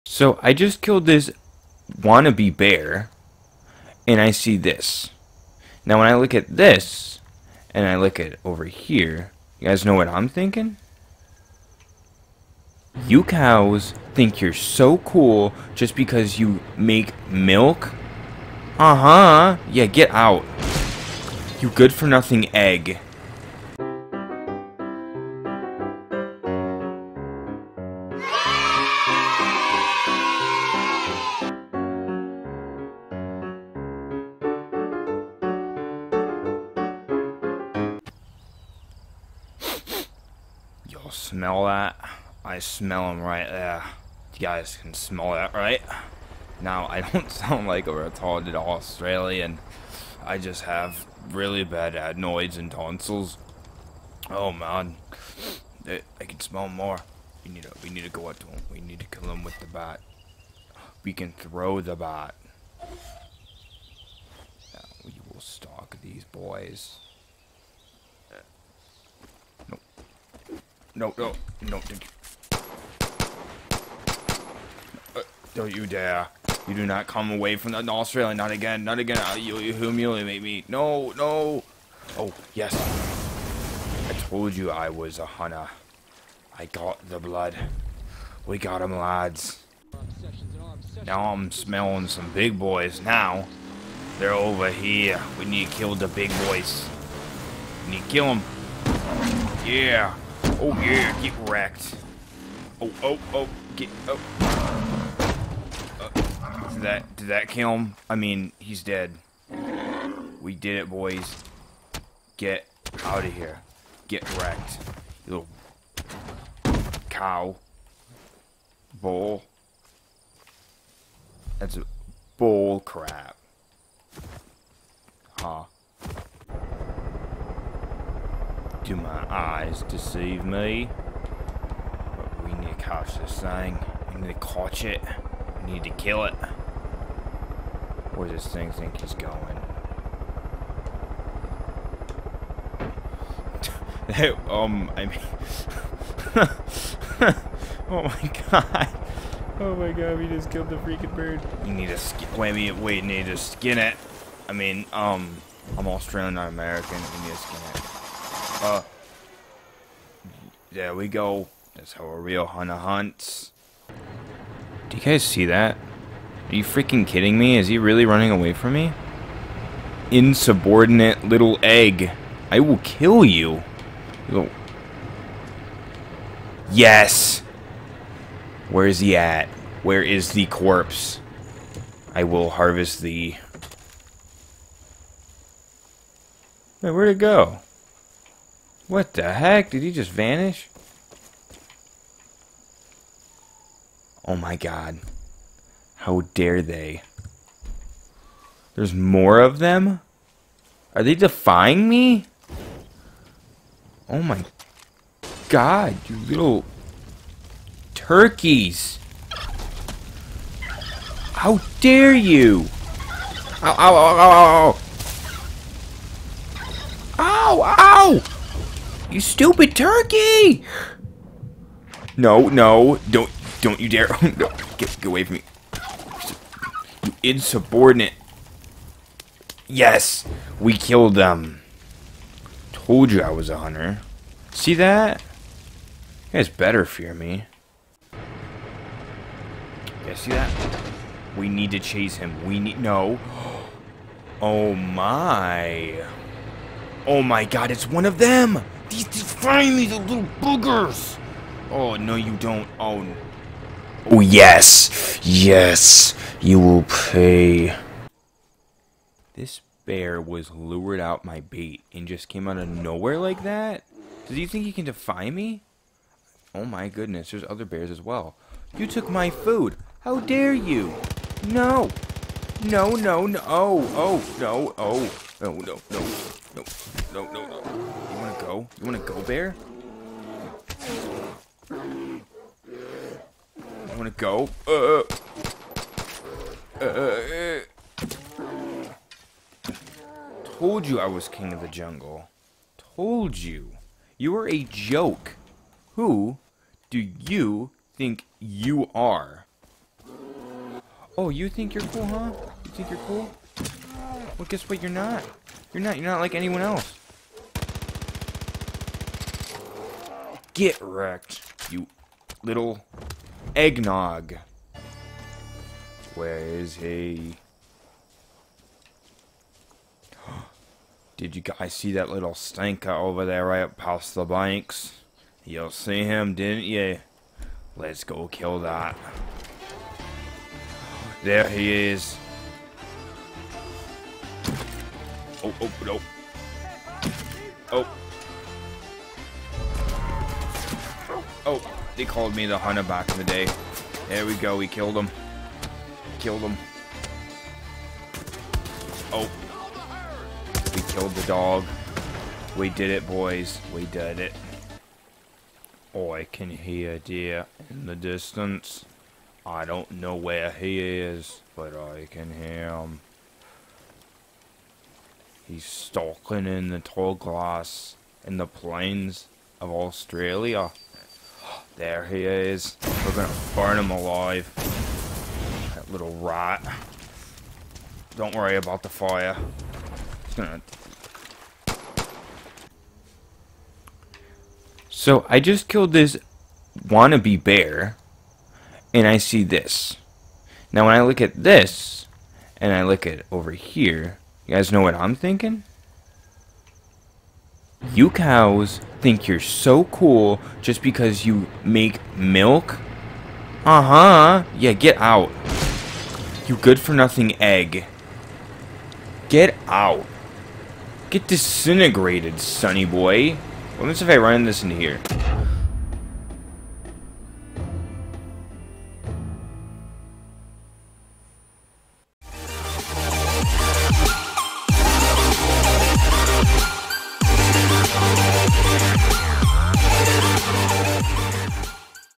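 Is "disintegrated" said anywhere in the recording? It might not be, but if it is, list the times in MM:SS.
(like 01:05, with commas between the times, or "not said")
06:51.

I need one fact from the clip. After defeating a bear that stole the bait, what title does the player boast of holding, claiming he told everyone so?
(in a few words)
king of the jungle.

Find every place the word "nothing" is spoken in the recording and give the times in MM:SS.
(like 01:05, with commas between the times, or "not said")
00:21, 06:46.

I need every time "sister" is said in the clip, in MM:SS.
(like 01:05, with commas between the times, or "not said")
not said.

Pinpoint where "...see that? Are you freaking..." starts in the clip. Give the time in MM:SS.
02:45.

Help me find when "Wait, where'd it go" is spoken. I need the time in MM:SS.
03:06.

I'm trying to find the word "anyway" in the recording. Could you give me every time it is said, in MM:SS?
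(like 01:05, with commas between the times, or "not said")
not said.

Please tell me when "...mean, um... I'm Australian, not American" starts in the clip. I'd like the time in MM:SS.
02:34.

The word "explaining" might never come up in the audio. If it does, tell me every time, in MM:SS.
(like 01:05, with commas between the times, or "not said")
not said.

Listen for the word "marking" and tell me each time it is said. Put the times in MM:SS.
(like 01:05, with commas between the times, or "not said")
not said.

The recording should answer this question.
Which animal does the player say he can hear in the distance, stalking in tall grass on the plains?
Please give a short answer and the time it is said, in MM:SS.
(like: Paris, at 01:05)
deer, at 05:56.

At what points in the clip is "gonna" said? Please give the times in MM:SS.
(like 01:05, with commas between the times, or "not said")
06:13, 06:20.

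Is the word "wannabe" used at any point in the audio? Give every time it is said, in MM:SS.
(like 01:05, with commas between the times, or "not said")
00:02, 06:26.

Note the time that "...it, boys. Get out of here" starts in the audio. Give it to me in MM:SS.
01:50.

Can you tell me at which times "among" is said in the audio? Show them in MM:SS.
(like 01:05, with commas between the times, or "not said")
not said.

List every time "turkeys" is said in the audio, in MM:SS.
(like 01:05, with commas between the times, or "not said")
03:27, 03:39.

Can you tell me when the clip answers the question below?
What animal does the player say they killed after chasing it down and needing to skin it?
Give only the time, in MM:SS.
02:31.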